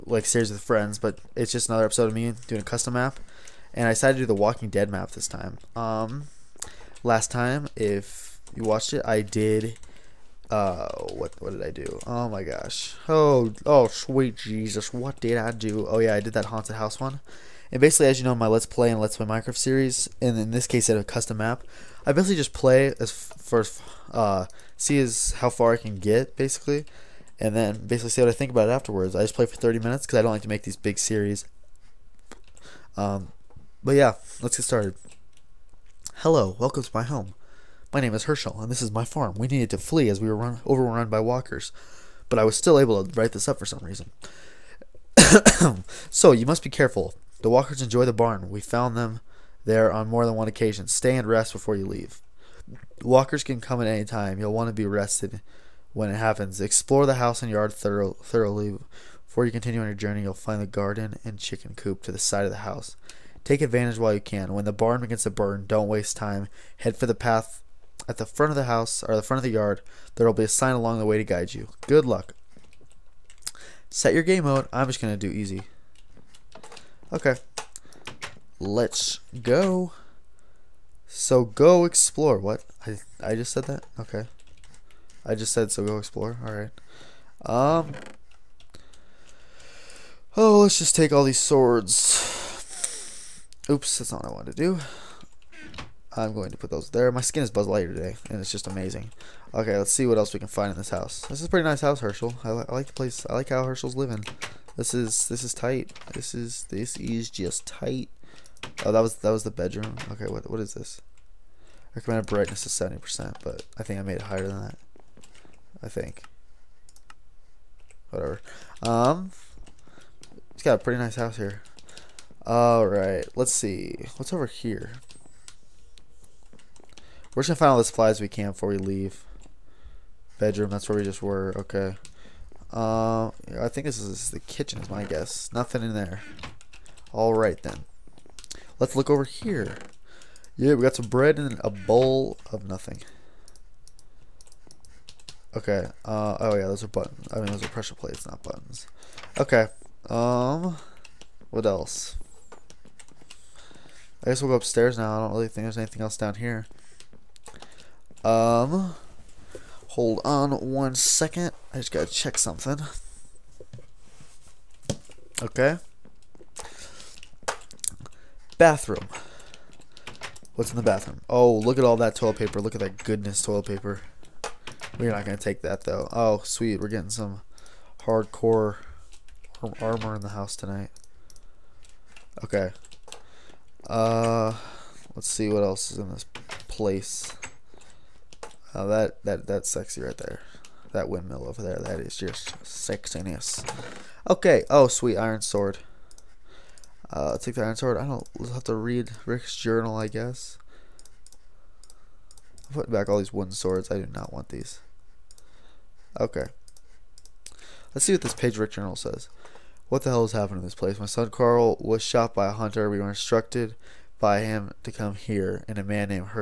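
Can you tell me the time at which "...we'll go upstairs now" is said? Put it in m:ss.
2:34.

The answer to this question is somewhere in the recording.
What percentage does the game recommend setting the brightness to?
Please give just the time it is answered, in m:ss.
1:52.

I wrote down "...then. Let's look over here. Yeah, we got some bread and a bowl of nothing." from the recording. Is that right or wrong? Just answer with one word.
right.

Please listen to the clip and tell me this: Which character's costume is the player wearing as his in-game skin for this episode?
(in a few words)
Buzz Lightyear.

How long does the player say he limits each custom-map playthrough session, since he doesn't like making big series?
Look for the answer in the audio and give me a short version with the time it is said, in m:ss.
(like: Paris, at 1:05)
30 minutes, at 0:29.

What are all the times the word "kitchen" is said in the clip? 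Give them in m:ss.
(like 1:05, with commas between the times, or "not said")
2:14.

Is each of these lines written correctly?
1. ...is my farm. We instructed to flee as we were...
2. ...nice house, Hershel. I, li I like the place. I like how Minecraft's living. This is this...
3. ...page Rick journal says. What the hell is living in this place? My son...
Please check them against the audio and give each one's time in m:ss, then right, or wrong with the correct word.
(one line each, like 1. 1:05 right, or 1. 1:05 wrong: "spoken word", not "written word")
1. 0:38 wrong: "needed", not "instructed"
2. 1:41 wrong: "Hershel", not "Minecraft"
3. 3:28 wrong: "happening", not "living".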